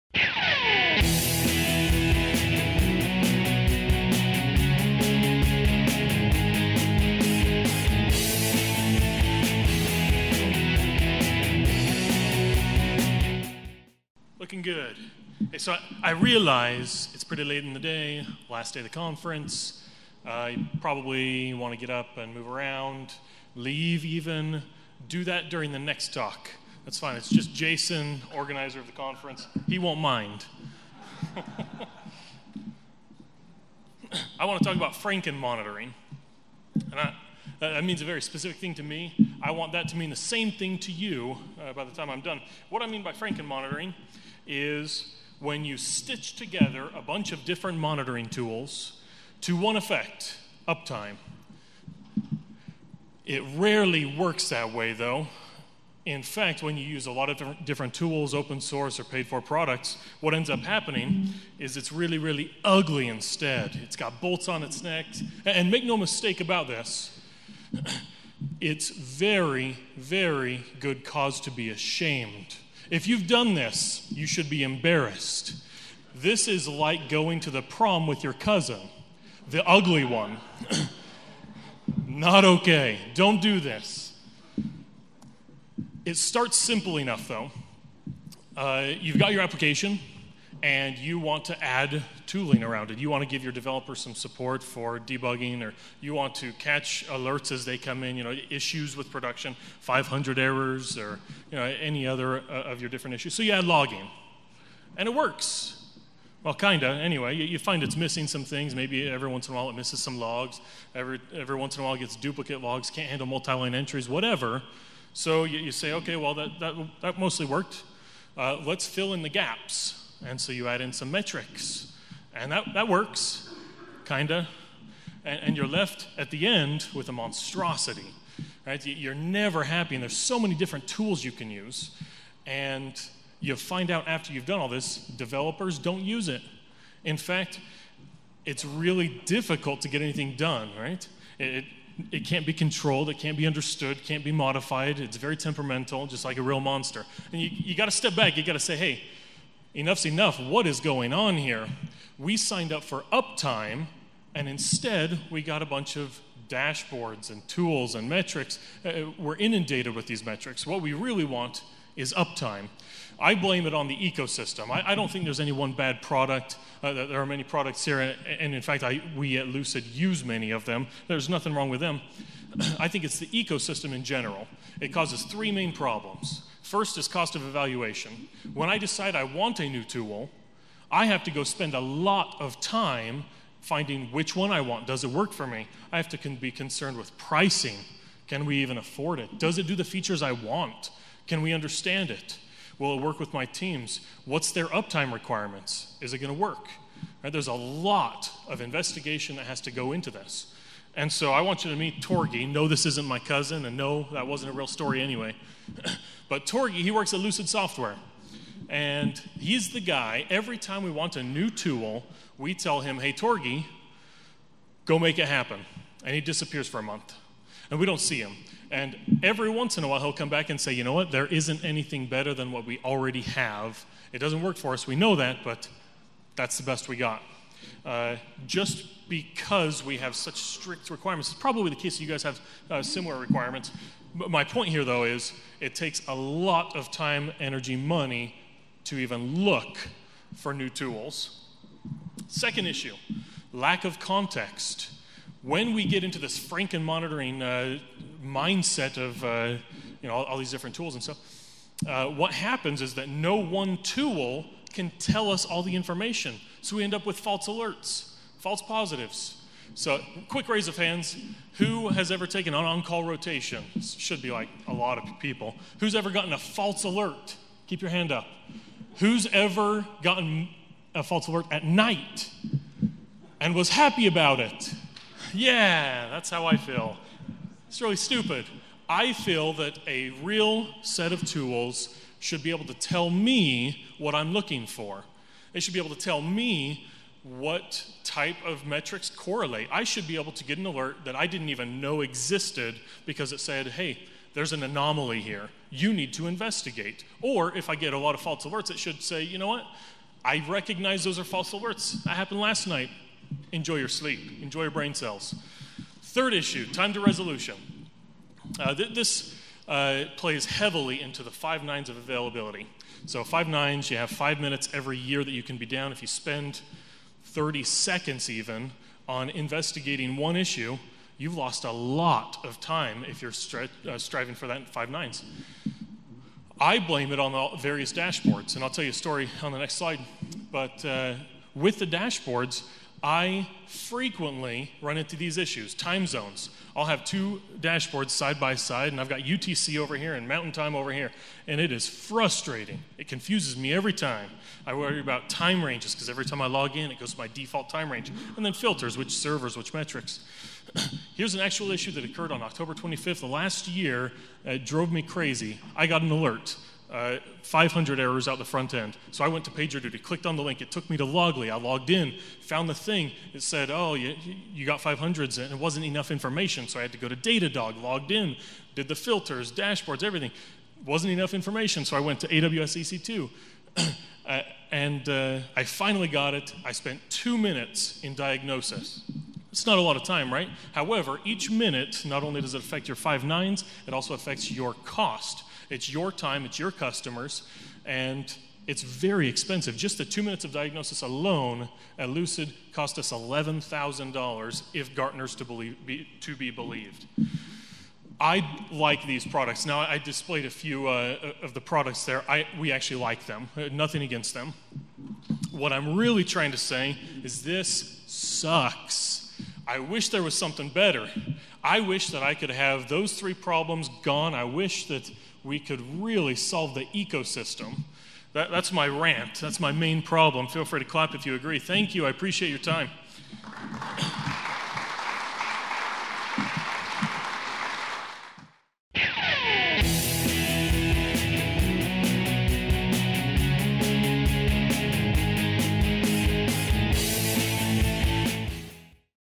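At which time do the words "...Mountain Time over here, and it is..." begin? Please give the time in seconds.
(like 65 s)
340 s.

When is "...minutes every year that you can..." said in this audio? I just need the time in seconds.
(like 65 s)
314 s.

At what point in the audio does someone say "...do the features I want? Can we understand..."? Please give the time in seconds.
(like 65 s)
189 s.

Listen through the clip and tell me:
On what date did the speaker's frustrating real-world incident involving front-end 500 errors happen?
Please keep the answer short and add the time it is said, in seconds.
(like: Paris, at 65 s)
October 25th, at 352 s.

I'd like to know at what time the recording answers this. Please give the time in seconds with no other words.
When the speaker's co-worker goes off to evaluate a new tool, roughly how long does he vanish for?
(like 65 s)
216 s.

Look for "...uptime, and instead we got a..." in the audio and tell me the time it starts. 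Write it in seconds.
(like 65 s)
153 s.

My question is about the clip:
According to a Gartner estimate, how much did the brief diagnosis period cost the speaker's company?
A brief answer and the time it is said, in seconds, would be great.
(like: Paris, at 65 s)
$11,000, at 393 s.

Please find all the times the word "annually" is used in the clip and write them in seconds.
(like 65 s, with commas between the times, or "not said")
not said.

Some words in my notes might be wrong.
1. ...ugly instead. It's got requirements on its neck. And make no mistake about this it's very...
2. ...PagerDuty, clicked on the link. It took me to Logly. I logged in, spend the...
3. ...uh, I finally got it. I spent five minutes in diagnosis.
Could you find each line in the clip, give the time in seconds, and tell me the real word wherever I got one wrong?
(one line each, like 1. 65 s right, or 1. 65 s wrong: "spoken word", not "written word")
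1. 62 s wrong: "bolts", not "requirements"
2. 359 s wrong: "found", not "spend"
3. 375 s wrong: "two", not "five".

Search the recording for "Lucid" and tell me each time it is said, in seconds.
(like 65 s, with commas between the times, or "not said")
169 s, 207 s, 392 s.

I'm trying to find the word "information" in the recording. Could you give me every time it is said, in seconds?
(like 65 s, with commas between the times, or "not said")
255 s, 366 s, 371 s.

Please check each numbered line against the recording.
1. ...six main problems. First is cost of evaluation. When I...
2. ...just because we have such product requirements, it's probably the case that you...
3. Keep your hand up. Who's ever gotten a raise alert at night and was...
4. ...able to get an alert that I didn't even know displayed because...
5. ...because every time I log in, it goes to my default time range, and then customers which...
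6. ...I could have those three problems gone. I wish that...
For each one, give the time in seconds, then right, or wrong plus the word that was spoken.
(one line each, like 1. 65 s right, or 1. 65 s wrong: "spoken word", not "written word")
1. 175 s wrong: "three", not "six"
2. 228 s wrong: "strict", not "product"
3. 267 s wrong: "false", not "raise"
4. 290 s wrong: "existed", not "displayed"
5. 345 s wrong: "filters", not "customers"
6. 412 s right.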